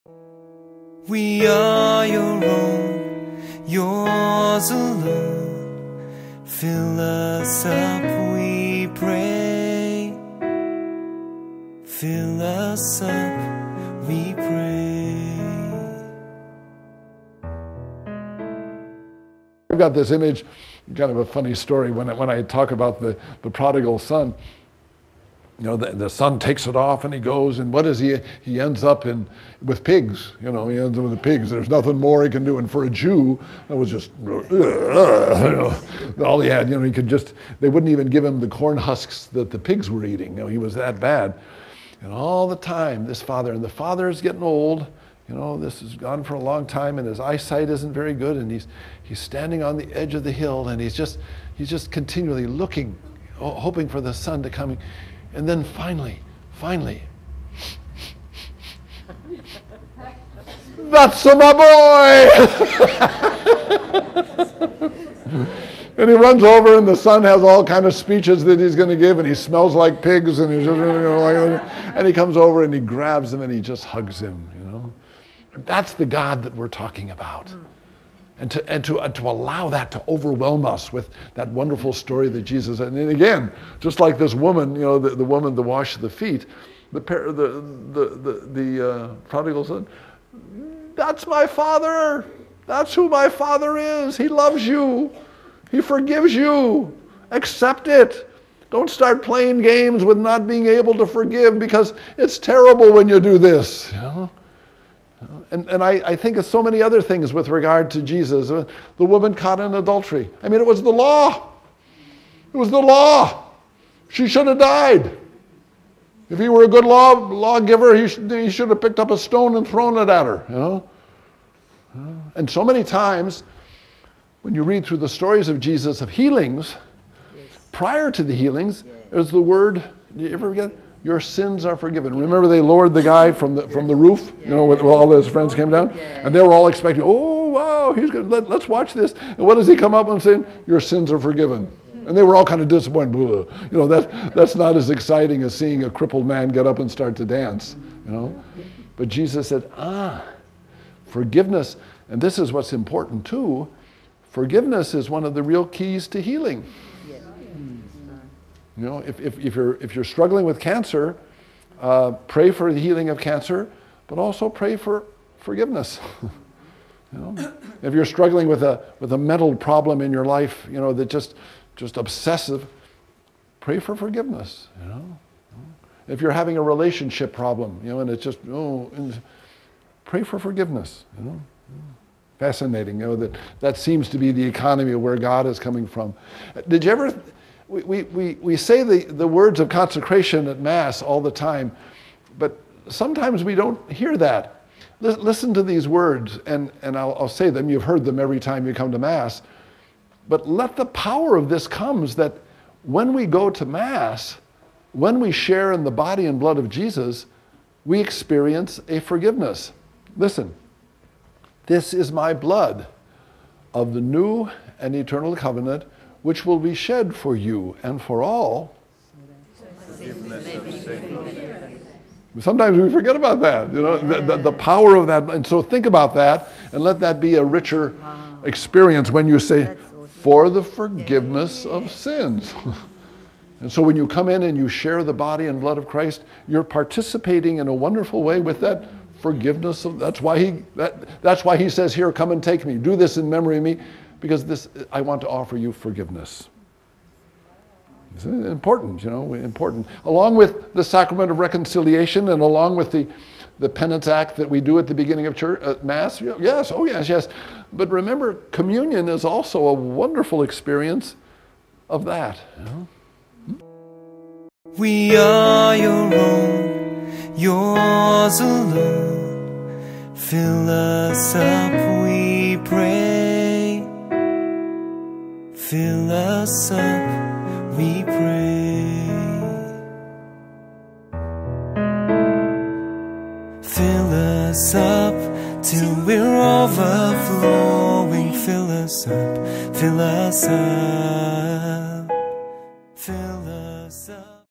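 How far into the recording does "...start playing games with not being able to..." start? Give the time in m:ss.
1:38.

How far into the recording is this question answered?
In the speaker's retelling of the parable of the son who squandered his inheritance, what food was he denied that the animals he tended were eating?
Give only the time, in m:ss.
0:38.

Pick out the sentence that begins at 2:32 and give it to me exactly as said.
And this is what's important, too.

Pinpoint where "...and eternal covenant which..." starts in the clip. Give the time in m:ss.
3:34.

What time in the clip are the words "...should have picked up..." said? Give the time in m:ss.
1:58.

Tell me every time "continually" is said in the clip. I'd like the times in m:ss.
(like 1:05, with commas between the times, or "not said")
0:51.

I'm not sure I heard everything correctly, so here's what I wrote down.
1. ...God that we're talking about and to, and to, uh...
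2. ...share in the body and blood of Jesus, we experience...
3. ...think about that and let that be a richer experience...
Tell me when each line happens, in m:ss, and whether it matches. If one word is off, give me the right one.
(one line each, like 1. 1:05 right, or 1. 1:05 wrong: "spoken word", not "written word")
1. 1:16 right
2. 3:25 right
3. 3:45 right.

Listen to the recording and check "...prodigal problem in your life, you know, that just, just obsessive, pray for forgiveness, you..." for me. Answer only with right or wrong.
wrong.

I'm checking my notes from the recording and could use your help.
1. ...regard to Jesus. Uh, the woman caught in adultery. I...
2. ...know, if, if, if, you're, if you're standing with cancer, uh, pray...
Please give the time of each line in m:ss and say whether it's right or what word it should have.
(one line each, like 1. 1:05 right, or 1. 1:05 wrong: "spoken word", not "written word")
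1. 1:47 right
2. 2:38 wrong: "struggling", not "standing".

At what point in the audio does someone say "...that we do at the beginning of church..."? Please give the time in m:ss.
4:14.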